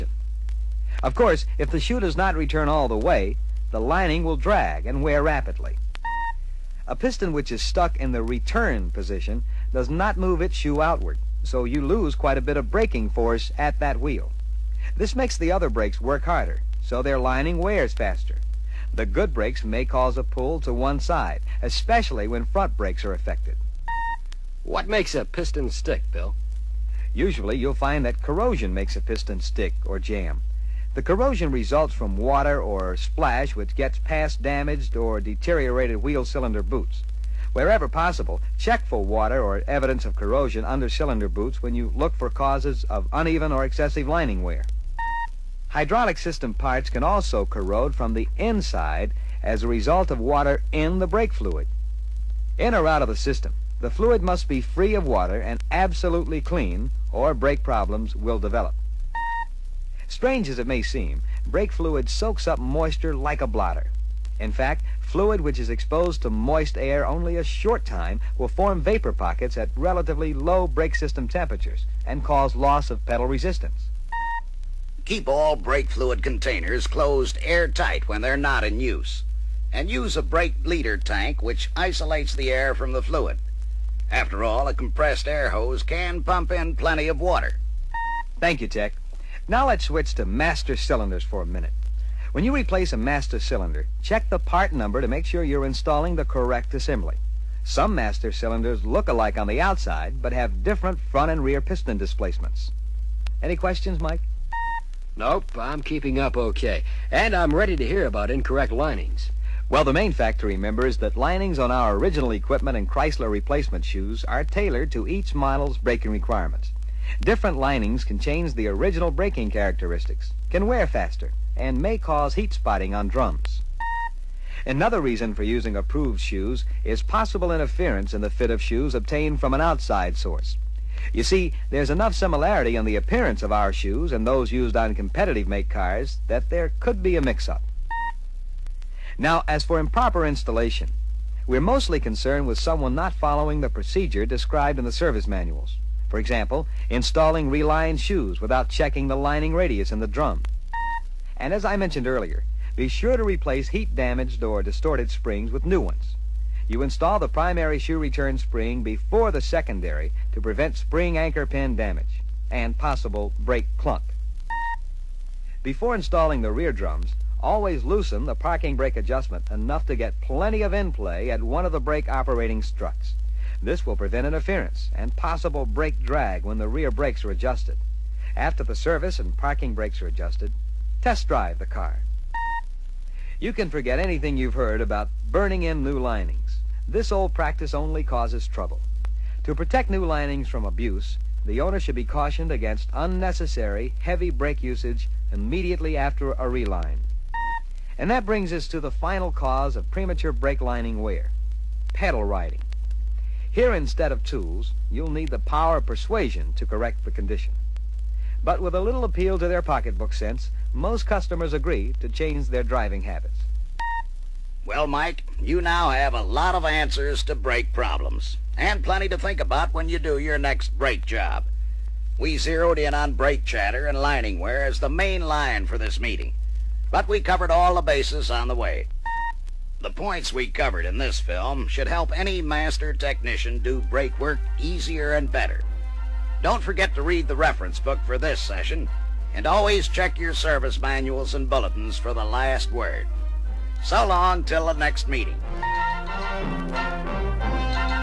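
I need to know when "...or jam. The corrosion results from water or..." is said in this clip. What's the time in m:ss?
0:29.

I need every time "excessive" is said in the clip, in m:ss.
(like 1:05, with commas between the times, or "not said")
0:43.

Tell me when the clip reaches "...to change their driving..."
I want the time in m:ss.
3:32.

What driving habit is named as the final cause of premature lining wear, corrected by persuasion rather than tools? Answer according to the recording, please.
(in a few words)
Pedal riding.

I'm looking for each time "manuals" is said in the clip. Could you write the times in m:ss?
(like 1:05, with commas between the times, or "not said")
2:25, 4:00.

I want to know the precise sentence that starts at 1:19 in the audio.
And use a brake bleeder tank which isolates the air from the fluid.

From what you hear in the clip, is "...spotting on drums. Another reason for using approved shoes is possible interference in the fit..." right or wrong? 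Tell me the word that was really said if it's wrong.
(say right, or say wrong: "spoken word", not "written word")
right.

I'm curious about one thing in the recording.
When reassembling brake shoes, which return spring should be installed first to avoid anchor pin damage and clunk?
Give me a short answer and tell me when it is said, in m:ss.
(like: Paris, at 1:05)
Primary shoe return spring, at 2:37.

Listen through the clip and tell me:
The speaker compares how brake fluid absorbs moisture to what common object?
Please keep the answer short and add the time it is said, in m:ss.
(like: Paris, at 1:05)
A blotter, at 1:03.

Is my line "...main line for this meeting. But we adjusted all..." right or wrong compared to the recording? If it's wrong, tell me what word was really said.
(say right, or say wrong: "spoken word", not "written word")
wrong: "covered", not "adjusted".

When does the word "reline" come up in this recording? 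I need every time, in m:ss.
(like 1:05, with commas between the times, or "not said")
2:27, 3:16.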